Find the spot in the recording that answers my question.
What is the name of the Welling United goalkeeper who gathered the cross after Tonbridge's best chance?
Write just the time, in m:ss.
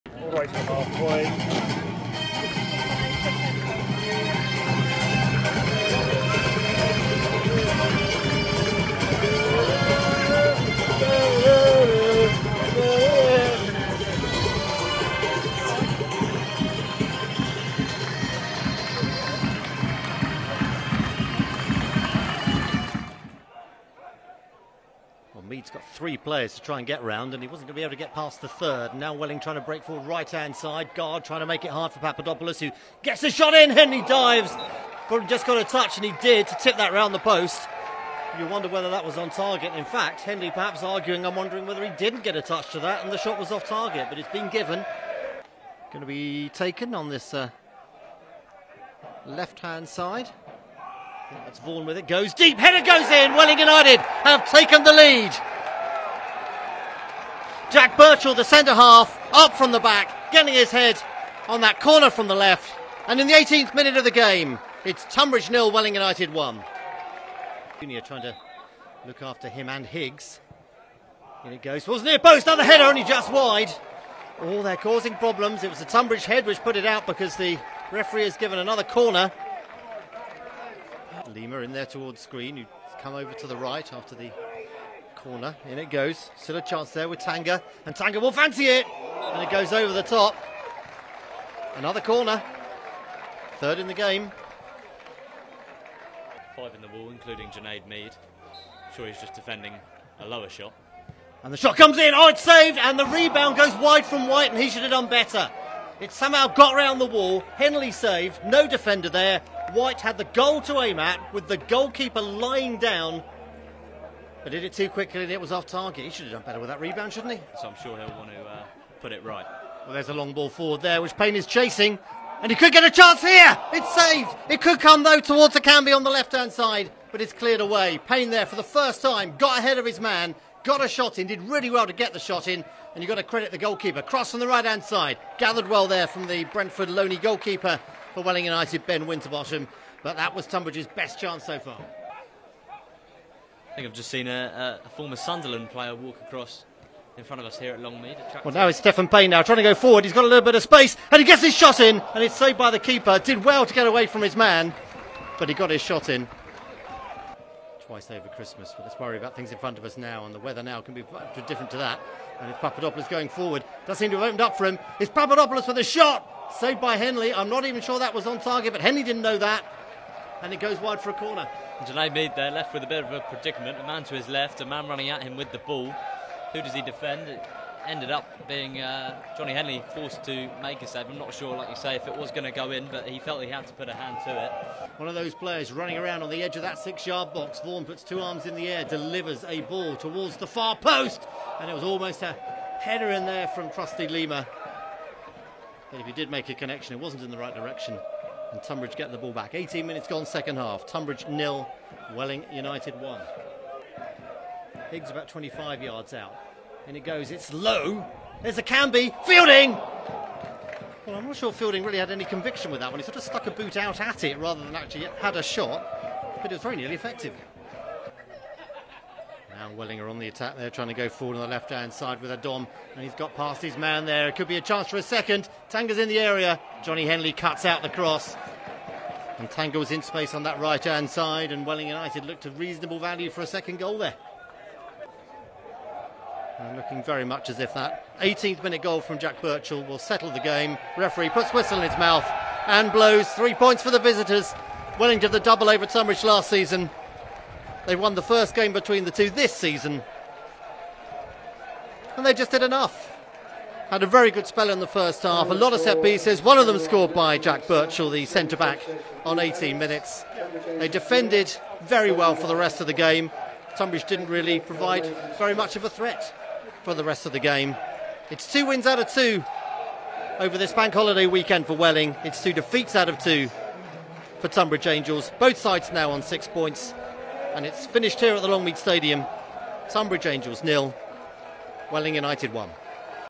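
2:18.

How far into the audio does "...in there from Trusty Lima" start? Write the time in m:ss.
3:13.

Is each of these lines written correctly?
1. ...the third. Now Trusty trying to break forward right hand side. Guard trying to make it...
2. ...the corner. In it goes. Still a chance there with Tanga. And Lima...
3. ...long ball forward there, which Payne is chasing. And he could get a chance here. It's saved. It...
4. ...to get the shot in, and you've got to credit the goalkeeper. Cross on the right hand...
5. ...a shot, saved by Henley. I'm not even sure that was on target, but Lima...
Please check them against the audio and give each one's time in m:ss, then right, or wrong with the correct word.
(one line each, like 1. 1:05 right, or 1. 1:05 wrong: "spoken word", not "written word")
1. 0:28 wrong: "Welling", not "Trusty"
2. 1:24 wrong: "Tanga", not "Lima"
3. 2:00 right
4. 2:11 right
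5. 2:45 wrong: "Henley", not "Lima".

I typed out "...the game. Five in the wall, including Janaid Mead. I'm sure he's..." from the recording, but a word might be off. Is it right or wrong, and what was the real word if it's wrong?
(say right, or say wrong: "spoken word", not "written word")
right.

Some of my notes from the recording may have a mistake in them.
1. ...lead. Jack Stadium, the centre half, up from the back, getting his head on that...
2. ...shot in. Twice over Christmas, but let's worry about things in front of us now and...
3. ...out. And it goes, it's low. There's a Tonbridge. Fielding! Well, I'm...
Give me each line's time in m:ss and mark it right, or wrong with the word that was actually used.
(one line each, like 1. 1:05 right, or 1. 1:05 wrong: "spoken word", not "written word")
1. 0:54 wrong: "Birchall", not "Stadium"
2. 2:35 right
3. 3:26 wrong: "Canby", not "Tonbridge".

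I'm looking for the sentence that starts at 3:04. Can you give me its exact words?
One of those players running around on the edge of that six yard box.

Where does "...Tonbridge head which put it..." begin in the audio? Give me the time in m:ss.
1:15.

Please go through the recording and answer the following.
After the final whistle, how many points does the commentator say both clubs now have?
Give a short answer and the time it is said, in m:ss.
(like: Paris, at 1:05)
6, at 4:36.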